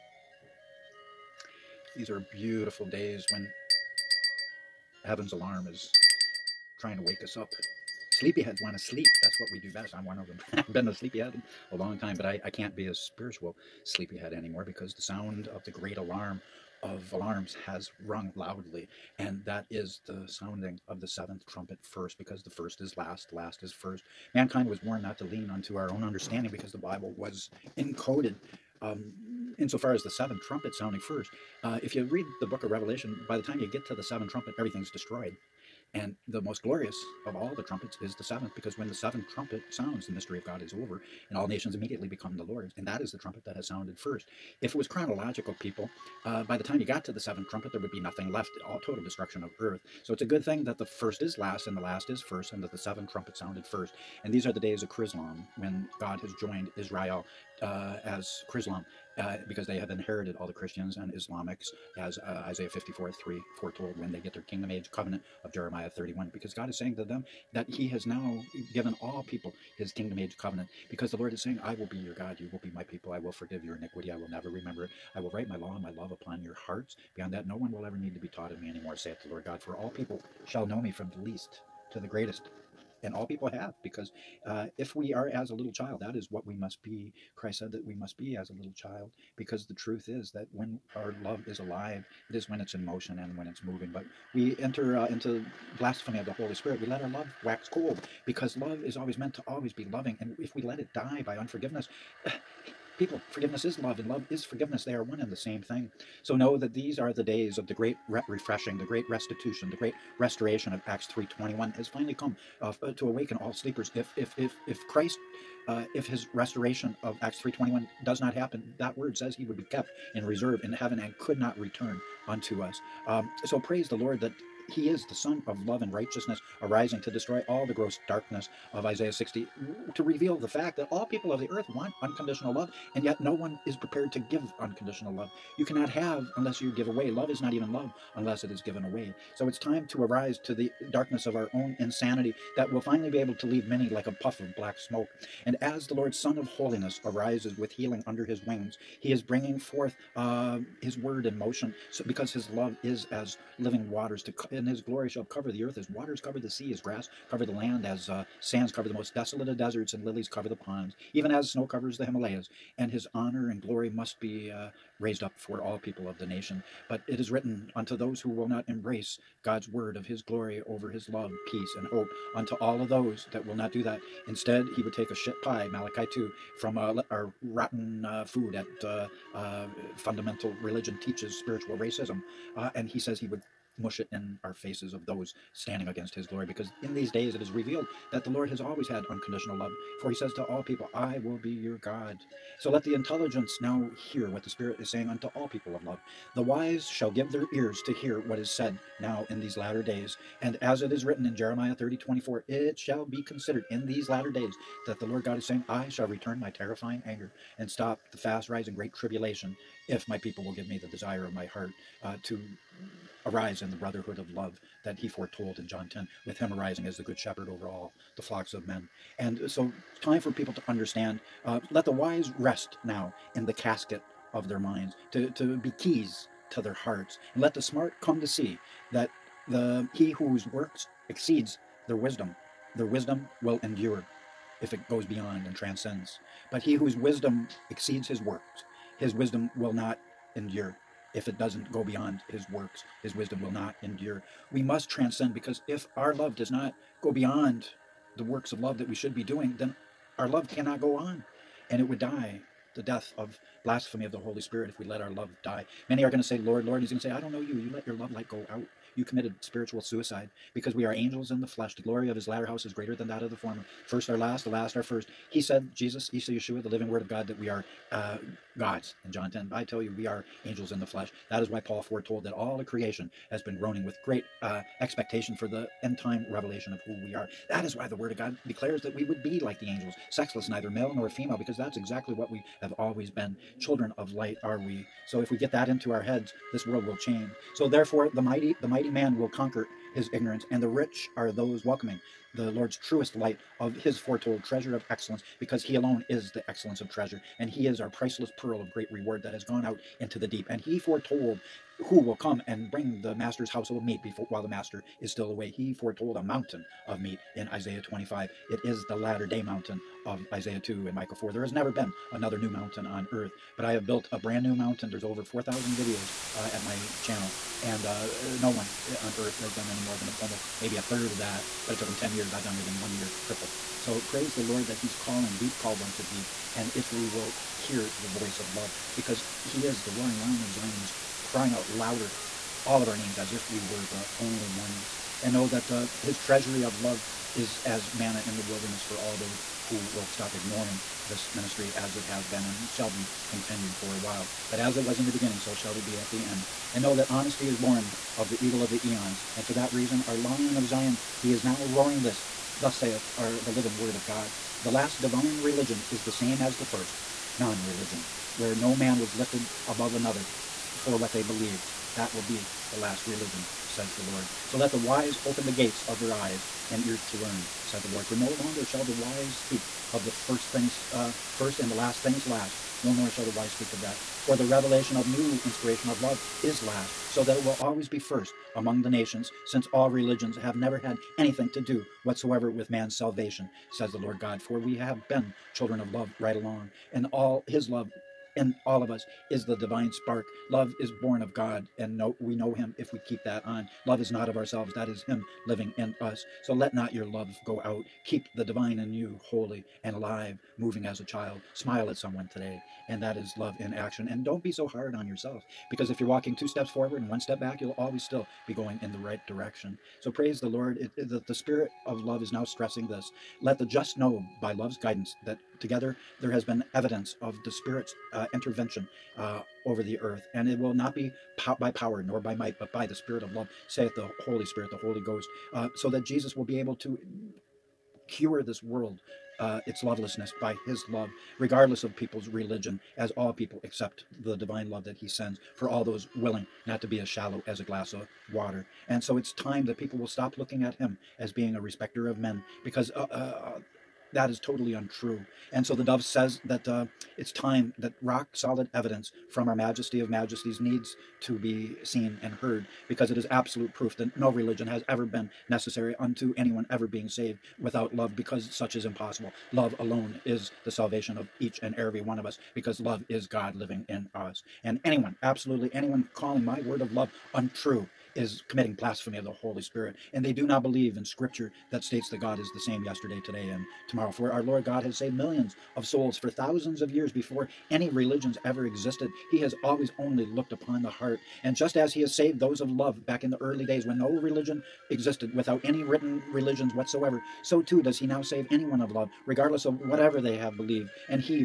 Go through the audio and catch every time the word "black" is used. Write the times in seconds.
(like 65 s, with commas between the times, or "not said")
144 s.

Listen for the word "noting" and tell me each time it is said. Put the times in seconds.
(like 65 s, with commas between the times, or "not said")
not said.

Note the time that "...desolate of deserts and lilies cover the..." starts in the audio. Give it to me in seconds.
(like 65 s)
159 s.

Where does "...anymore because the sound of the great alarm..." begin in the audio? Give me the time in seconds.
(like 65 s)
14 s.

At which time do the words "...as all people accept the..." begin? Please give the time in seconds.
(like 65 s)
432 s.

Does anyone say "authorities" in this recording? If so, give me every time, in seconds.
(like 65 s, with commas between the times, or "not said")
not said.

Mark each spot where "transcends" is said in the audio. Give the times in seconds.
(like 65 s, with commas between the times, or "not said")
235 s, 244 s.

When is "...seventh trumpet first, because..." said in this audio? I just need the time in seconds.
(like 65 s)
21 s.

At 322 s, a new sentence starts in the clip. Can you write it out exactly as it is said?
I've done it in one year, triple.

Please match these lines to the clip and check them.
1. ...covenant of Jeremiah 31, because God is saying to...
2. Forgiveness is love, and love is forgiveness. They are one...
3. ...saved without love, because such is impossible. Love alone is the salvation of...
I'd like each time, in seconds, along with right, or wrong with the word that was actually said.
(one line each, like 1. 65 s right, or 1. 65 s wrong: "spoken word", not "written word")
1. 64 s right
2. 103 s right
3. 457 s right.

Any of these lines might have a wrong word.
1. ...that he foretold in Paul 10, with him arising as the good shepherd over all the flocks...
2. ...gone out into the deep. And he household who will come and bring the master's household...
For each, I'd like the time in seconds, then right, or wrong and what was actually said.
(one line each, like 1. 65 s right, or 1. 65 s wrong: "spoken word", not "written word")
1. 214 s wrong: "John", not "Paul"
2. 299 s wrong: "foretold", not "household".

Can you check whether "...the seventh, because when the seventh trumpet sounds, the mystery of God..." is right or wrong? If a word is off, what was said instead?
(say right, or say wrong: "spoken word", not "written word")
right.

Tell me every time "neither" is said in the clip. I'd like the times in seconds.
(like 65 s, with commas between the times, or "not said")
280 s.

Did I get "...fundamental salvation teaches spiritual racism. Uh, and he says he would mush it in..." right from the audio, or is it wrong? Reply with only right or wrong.
wrong.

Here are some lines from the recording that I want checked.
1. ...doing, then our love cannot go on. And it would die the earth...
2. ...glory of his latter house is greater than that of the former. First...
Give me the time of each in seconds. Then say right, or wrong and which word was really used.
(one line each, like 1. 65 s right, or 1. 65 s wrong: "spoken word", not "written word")
1. 249 s wrong: "death", not "earth"
2. 261 s right.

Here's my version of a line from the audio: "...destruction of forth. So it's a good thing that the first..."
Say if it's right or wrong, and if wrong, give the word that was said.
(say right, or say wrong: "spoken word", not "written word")
wrong: "earth", not "forth".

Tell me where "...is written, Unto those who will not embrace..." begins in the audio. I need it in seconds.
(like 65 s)
167 s.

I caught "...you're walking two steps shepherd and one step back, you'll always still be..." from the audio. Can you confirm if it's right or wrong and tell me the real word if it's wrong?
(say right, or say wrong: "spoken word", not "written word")
wrong: "forward", not "shepherd".